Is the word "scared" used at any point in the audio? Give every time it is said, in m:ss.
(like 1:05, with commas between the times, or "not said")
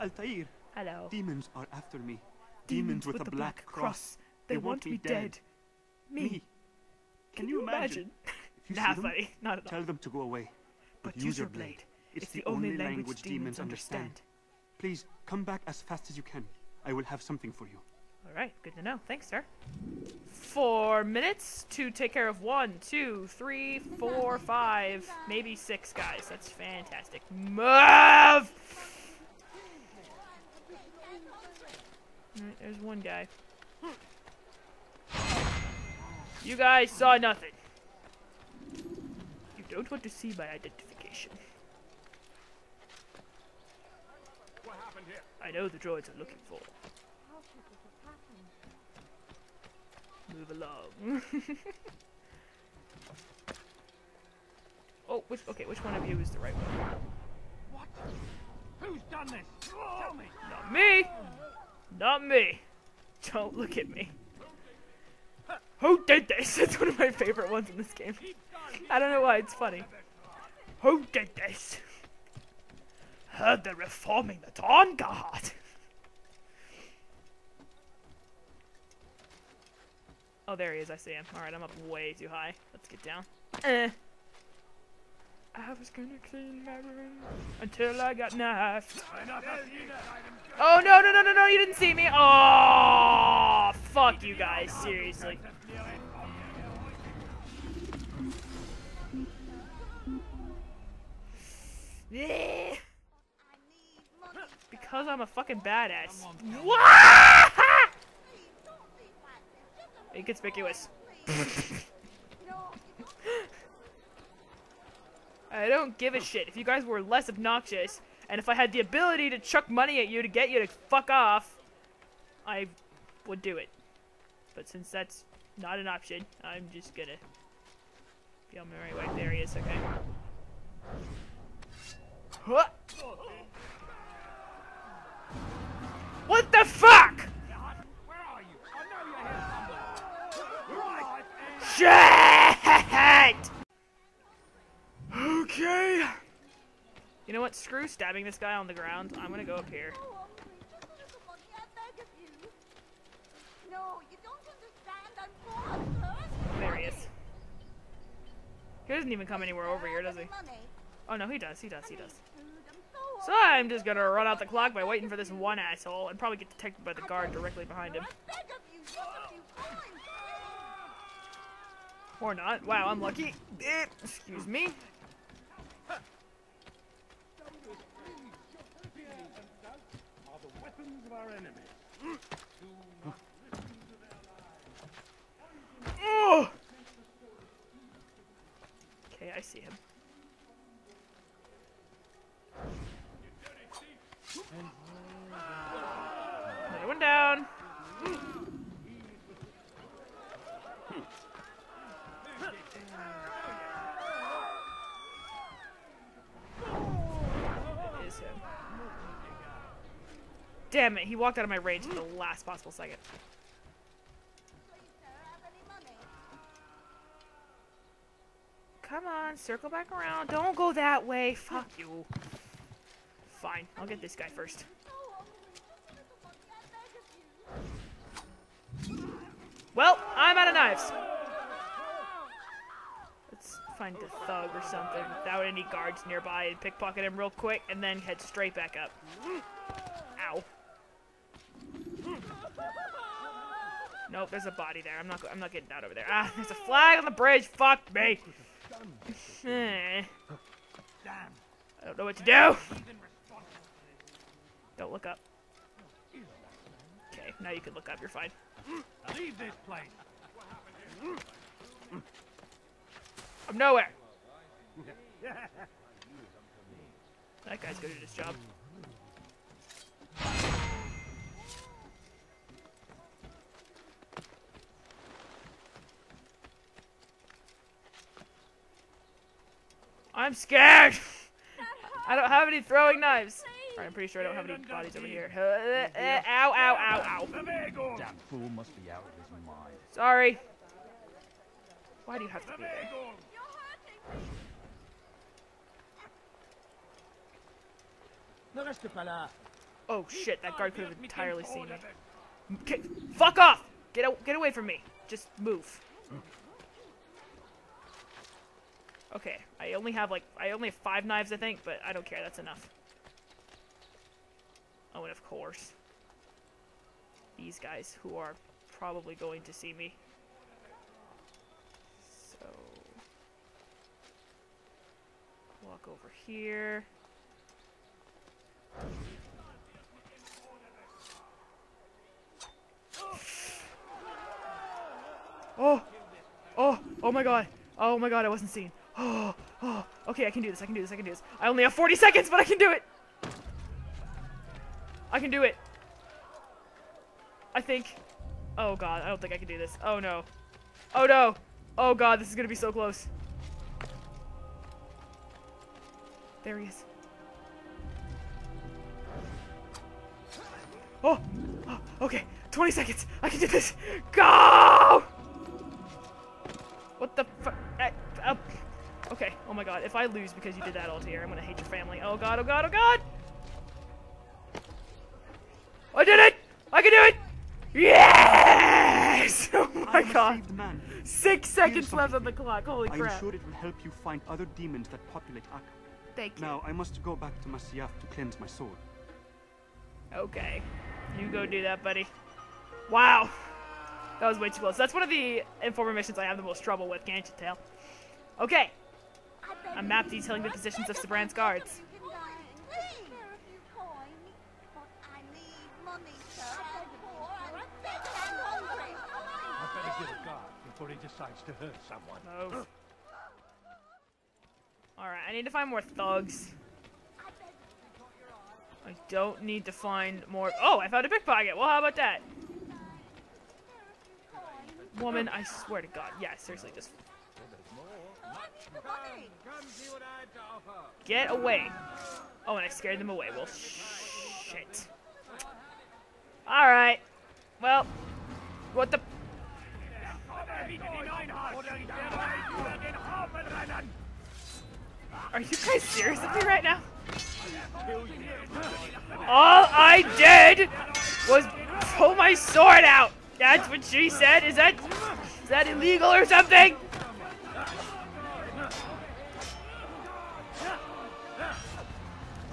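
4:40, 7:12.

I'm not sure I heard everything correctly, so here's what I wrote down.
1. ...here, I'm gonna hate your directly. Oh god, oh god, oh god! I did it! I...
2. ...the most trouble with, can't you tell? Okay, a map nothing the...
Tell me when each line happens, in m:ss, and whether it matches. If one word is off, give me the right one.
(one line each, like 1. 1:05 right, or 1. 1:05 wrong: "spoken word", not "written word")
1. 6:11 wrong: "family", not "directly"
2. 6:36 wrong: "detailing", not "nothing".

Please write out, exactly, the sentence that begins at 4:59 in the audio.
Oh shit, that guard could have entirely seen me.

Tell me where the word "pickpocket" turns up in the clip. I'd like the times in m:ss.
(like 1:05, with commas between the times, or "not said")
3:56, 7:01.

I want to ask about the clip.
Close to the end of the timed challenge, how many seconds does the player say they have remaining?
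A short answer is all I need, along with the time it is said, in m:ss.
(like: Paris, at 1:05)
40 seconds, at 5:41.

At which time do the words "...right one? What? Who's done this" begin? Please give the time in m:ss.
0:56.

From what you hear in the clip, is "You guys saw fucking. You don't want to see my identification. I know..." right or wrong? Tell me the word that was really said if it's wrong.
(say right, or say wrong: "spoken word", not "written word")
wrong: "nothing", not "fucking".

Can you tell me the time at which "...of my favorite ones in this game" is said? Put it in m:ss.
1:06.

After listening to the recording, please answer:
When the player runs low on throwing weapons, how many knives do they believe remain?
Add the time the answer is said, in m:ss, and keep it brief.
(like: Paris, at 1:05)
5, at 5:10.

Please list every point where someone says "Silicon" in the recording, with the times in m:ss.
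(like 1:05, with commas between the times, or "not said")
not said.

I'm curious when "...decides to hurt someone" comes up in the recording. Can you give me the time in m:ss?
6:51.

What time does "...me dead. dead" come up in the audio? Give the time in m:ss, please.
0:04.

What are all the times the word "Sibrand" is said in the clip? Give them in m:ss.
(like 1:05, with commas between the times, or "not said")
6:40.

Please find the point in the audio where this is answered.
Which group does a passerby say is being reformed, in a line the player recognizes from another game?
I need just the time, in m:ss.
1:14.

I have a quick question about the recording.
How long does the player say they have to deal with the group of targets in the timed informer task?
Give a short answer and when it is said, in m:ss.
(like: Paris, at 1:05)
4 minutes, at 0:20.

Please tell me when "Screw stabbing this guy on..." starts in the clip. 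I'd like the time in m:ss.
2:27.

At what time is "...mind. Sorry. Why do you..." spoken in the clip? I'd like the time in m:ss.
4:49.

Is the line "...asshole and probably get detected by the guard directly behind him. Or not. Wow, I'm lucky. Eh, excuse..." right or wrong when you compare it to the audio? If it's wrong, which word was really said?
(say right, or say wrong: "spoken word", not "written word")
right.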